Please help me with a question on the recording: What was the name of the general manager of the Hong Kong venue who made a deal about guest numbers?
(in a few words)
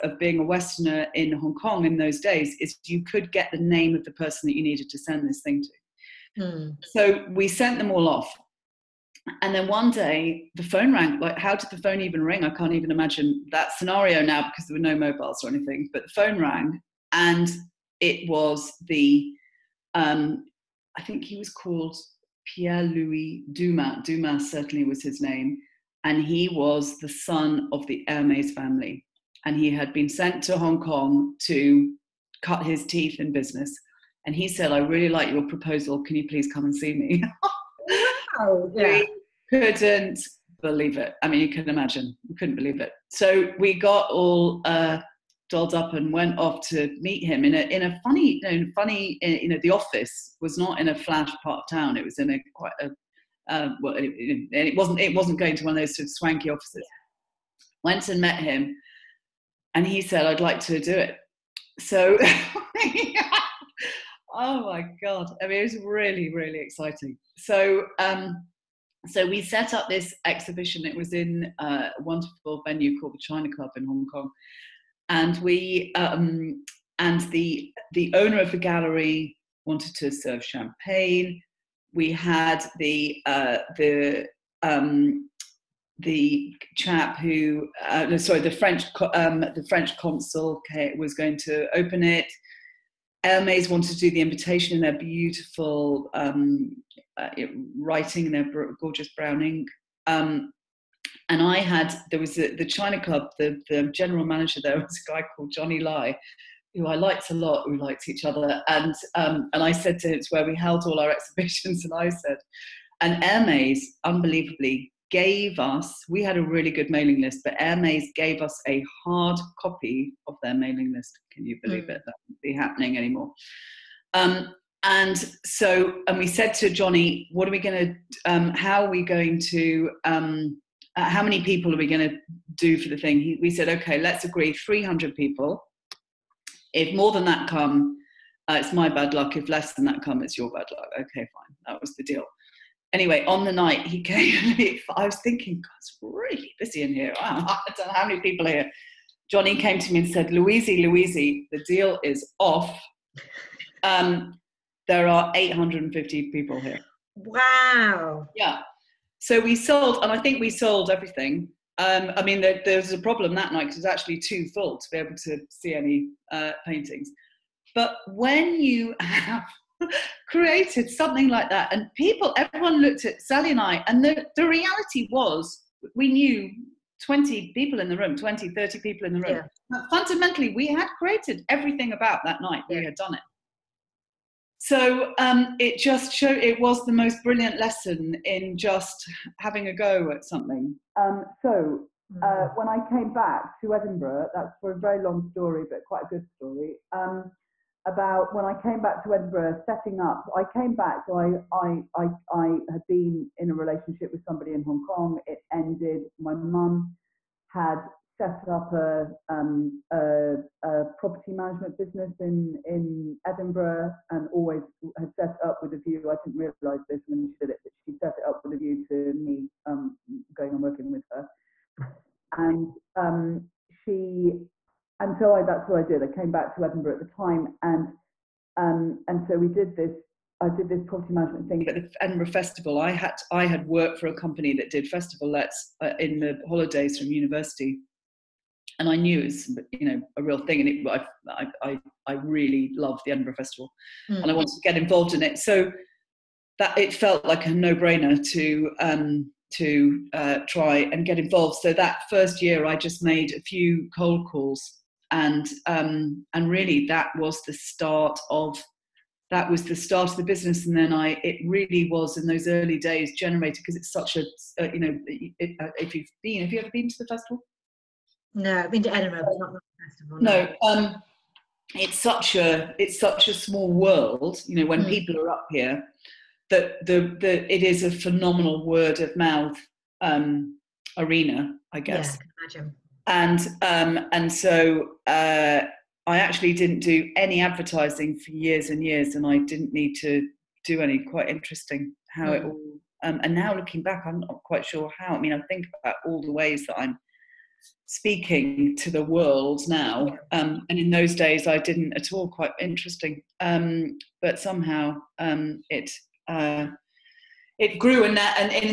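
Johnny Lai.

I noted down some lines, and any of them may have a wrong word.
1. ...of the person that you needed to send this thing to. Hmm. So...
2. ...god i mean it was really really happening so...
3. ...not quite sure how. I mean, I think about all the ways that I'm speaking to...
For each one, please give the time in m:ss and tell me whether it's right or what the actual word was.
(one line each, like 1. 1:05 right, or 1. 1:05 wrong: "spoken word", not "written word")
1. 0:03 right
2. 1:05 wrong: "exciting", not "happening"
3. 4:54 right.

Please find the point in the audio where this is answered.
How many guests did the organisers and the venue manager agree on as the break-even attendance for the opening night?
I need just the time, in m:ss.
2:14.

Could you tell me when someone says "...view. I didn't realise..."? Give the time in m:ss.
3:35.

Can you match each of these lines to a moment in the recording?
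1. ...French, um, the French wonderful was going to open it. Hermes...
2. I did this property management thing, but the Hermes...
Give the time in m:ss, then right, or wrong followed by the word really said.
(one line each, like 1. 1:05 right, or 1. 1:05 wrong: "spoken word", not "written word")
1. 1:28 wrong: "consul", not "wonderful"
2. 3:50 wrong: "Edinburgh", not "Hermes".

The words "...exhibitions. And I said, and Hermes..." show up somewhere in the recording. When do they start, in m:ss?
1:51.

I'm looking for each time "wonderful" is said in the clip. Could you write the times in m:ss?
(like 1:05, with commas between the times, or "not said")
1:11.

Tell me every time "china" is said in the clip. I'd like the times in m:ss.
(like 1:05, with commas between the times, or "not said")
1:13, 1:42.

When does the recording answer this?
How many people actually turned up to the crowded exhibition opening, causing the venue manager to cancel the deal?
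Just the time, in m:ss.
2:35.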